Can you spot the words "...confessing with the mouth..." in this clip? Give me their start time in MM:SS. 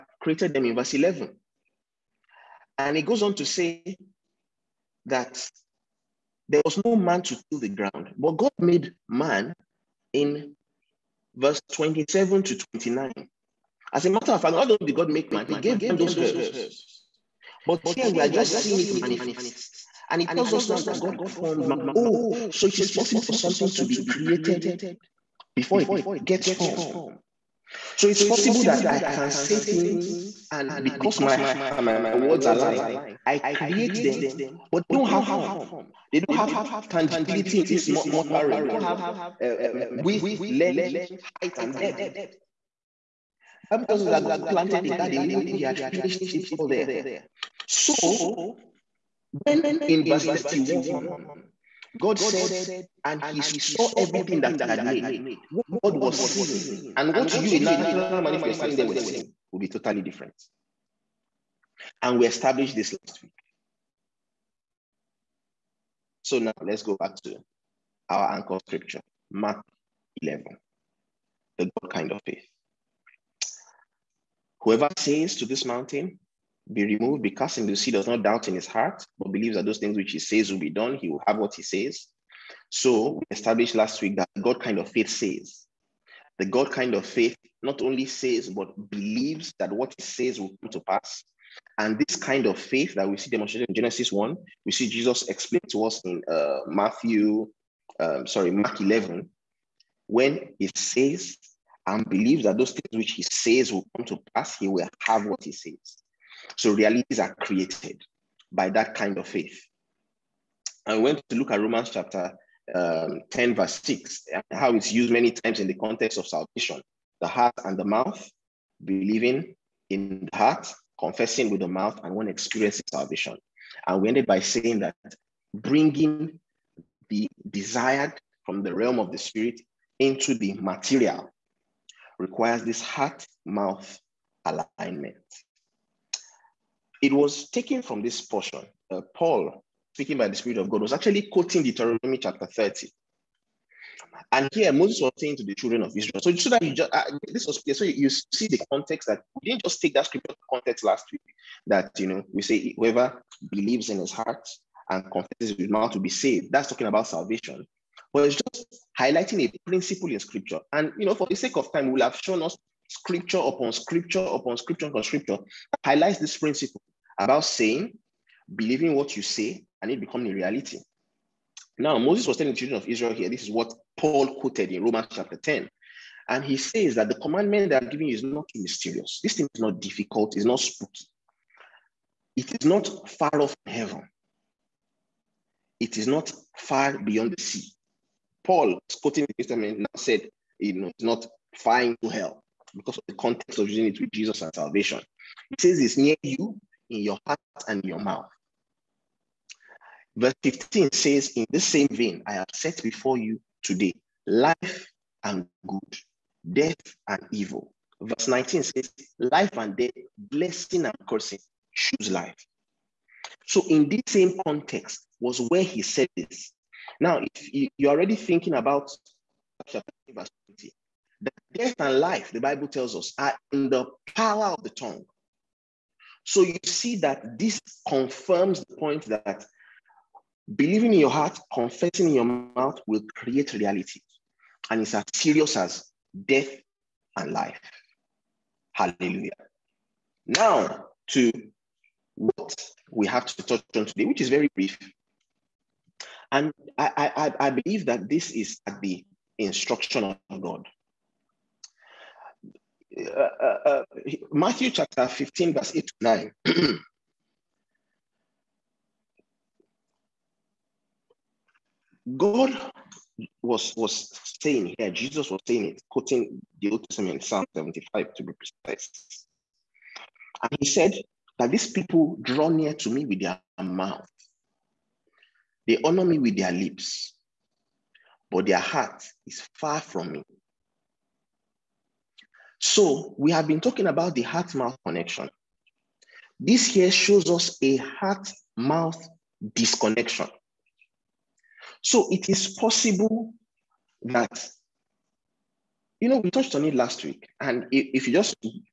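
02:00.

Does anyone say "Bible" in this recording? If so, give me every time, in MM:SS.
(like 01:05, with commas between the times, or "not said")
00:43, 03:42.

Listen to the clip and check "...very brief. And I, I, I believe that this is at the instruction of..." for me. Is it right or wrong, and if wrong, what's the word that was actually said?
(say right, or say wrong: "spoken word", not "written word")
right.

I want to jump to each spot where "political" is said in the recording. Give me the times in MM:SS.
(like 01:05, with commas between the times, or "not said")
not said.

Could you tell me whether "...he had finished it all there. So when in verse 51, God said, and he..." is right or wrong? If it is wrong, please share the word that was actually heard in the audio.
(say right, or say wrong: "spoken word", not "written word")
wrong: "31", not "51".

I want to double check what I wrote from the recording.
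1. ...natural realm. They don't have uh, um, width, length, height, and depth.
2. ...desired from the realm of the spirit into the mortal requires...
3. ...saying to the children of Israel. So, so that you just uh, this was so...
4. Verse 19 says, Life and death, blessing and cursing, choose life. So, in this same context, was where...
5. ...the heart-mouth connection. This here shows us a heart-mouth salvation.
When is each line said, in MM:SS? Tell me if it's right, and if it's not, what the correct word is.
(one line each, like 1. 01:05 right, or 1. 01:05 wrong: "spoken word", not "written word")
1. 00:37 wrong: "mortal", not "natural"
2. 02:07 wrong: "material", not "mortal"
3. 02:25 right
4. 03:28 right
5. 04:44 wrong: "disconnection", not "salvation".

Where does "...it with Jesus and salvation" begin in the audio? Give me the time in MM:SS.
03:13.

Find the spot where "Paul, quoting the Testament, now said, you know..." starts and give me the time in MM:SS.
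03:08.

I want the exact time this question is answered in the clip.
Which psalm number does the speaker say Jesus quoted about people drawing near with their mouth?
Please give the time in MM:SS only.
04:27.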